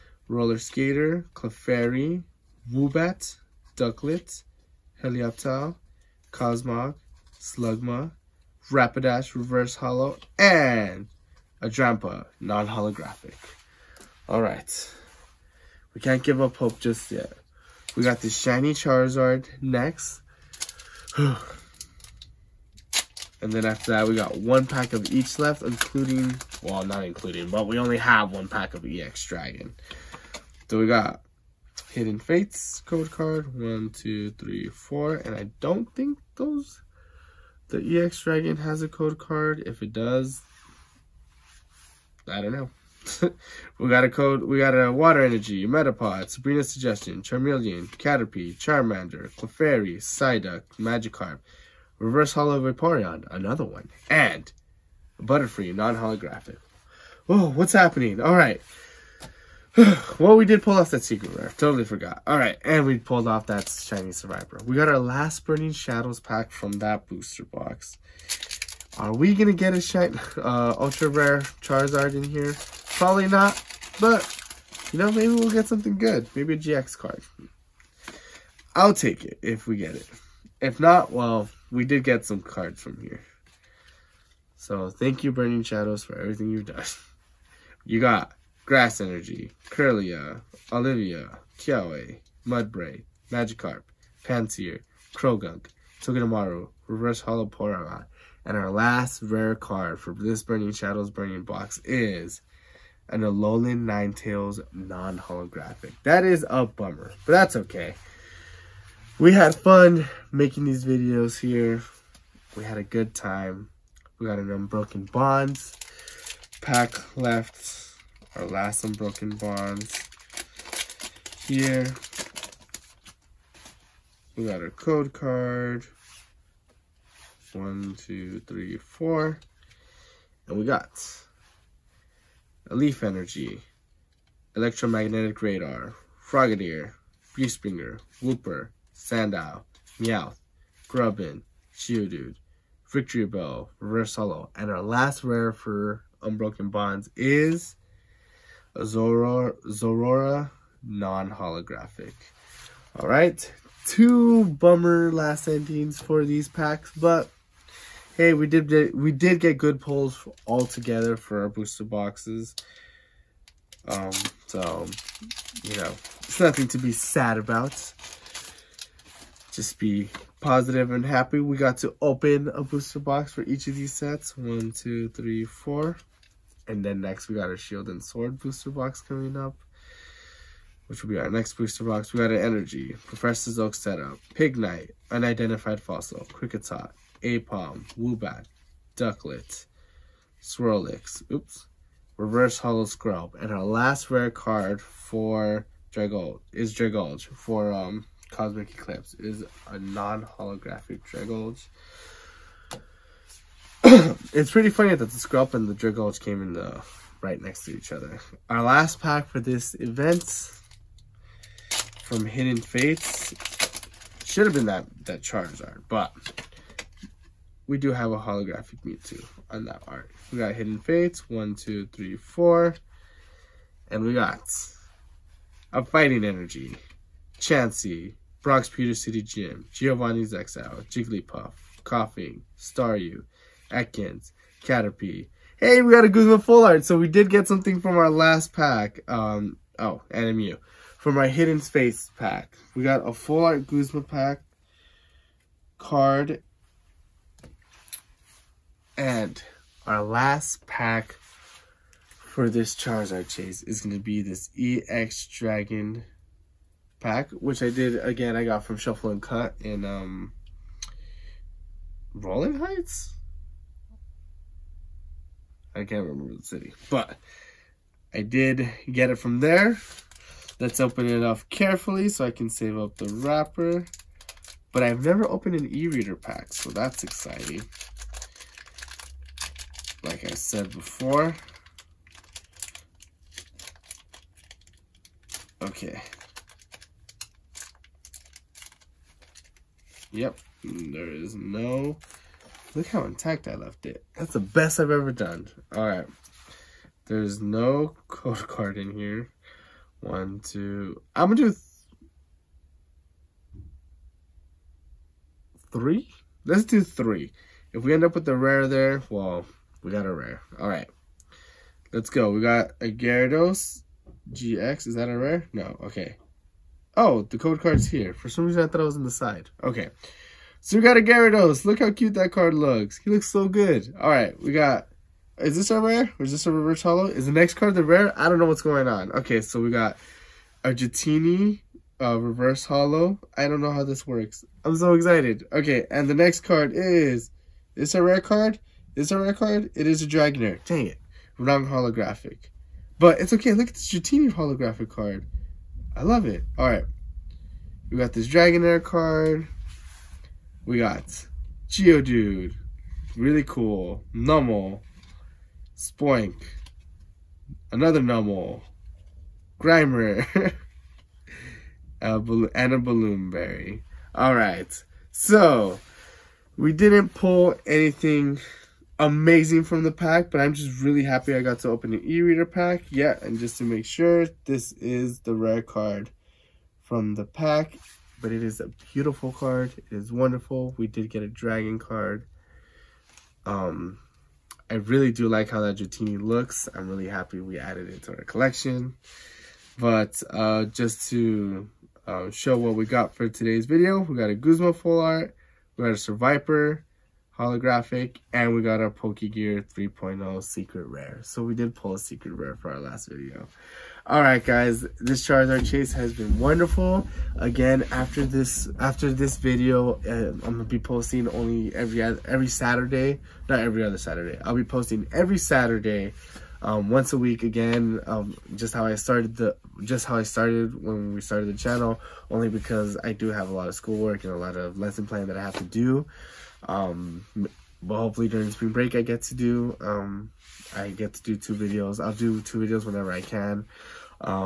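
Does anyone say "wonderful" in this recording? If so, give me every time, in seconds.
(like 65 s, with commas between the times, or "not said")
380 s, 406 s.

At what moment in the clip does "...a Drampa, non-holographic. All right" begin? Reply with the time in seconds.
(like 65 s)
11 s.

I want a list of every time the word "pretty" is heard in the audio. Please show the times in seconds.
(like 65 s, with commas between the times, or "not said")
204 s.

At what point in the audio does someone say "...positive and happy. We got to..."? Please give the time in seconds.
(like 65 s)
170 s.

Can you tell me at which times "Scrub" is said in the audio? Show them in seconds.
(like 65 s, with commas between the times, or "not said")
192 s, 205 s.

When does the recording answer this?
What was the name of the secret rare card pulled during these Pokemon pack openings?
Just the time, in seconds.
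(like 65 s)
398 s.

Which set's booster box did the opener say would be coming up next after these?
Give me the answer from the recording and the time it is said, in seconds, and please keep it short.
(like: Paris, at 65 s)
Shield and Sword, at 177 s.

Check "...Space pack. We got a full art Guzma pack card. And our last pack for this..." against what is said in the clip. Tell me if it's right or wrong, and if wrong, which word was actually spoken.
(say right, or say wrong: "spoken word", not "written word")
right.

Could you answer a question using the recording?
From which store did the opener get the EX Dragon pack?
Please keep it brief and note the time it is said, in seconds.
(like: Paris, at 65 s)
Shuffle and Cut, at 258 s.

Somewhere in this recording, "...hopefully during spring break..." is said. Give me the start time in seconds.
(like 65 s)
427 s.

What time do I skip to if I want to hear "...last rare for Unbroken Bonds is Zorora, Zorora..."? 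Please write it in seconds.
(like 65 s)
144 s.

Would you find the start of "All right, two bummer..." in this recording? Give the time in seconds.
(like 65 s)
152 s.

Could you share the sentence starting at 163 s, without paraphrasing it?
Um, so you know, it's nothing to be sad about.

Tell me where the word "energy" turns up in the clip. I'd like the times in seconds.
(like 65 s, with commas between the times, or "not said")
45 s, 88 s, 133 s, 182 s, 226 s.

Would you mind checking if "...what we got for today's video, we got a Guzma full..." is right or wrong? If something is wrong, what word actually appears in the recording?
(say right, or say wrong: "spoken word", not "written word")
right.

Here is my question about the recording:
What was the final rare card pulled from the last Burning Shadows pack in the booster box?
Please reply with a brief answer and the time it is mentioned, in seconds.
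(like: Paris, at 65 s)
Alolan Ninetales, at 103 s.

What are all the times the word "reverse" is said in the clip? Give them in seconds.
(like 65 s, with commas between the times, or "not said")
9 s, 51 s, 96 s, 143 s, 192 s, 326 s, 332 s.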